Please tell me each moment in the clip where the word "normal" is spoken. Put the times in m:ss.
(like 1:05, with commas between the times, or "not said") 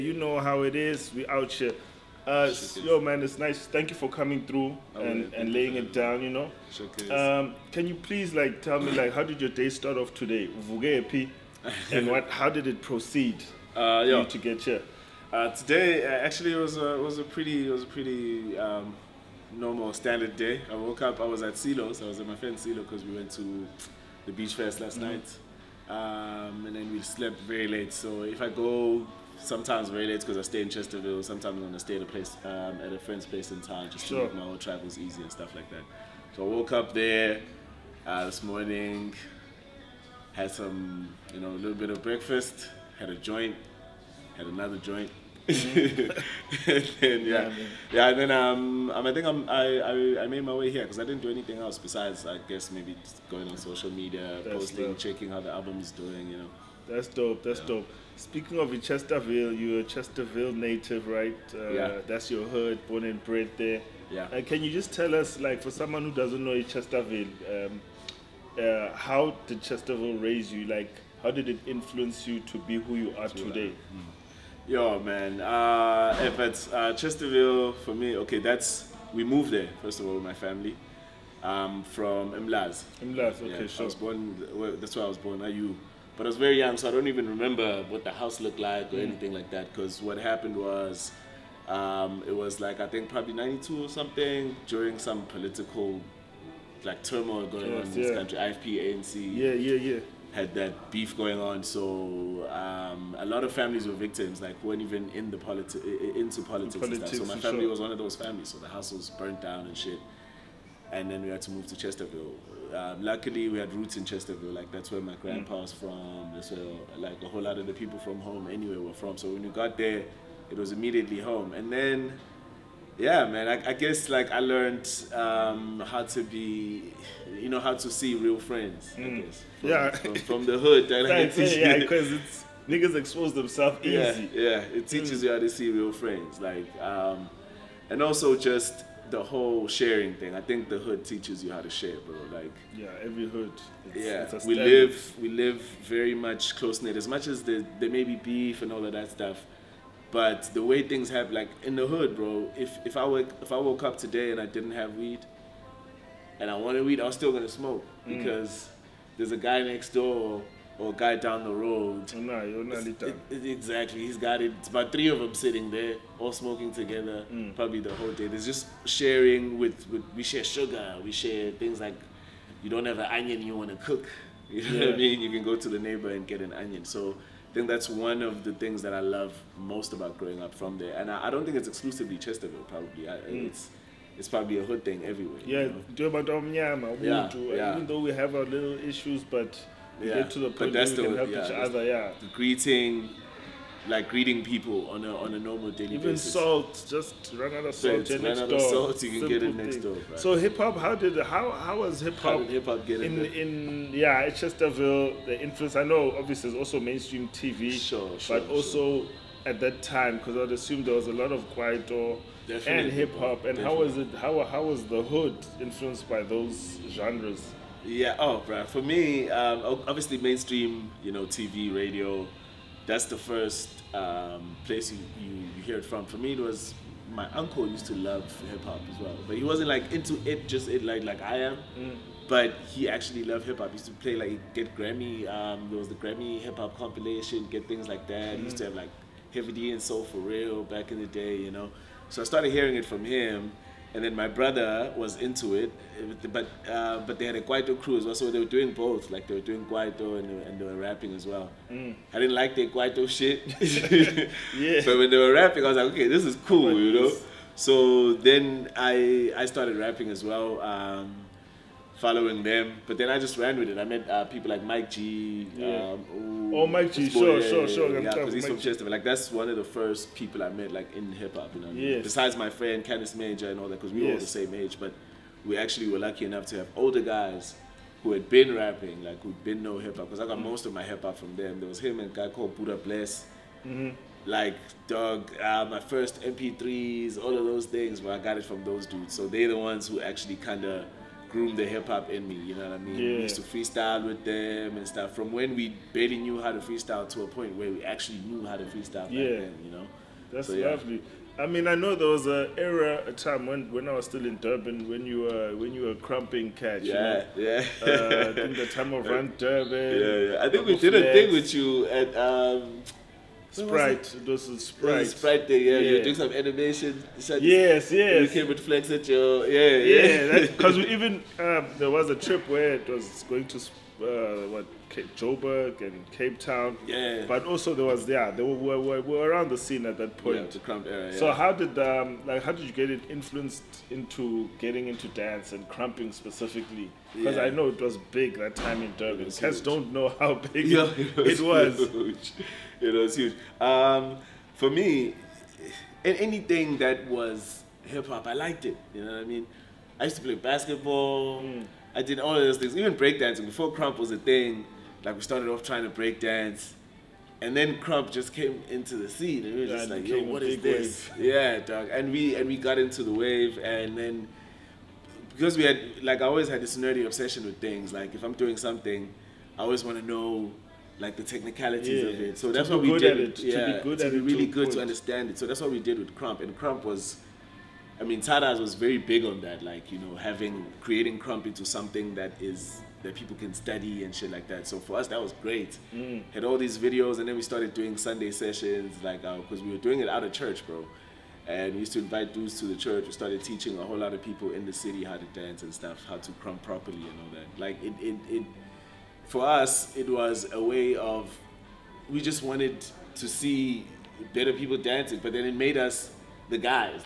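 0:19, 3:15.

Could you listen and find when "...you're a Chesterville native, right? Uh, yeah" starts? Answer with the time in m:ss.
0:59.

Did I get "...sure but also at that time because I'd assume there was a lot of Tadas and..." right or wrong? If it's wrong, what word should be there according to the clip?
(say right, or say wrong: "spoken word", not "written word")
wrong: "Kwaito", not "Tadas".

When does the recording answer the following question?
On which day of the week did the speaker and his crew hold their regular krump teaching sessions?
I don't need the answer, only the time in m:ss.
6:27.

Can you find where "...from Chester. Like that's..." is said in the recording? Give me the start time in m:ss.
4:28.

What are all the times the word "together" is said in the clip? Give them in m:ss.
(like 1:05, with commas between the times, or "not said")
2:46.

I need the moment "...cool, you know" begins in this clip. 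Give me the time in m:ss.
4:16.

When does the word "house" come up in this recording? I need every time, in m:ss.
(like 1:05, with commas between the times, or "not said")
1:28, 1:48.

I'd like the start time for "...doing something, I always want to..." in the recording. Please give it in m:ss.
6:08.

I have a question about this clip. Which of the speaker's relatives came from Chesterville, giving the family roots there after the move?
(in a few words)
grandpa.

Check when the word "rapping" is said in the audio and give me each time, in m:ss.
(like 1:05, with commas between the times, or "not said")
4:10, 4:15, 4:19, 4:38.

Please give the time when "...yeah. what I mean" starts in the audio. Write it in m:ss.
2:54.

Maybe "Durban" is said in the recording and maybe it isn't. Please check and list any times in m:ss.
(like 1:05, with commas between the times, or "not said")
5:04, 5:09, 5:38.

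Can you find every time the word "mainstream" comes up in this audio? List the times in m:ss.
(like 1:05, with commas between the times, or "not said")
3:26, 3:40.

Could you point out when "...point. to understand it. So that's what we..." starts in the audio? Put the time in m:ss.
6:14.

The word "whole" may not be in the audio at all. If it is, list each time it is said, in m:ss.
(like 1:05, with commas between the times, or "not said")
0:34, 1:57, 2:19, 2:47, 6:33.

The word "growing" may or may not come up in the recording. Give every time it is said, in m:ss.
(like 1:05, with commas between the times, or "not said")
3:00.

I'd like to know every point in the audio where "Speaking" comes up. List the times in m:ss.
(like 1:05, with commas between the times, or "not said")
0:58.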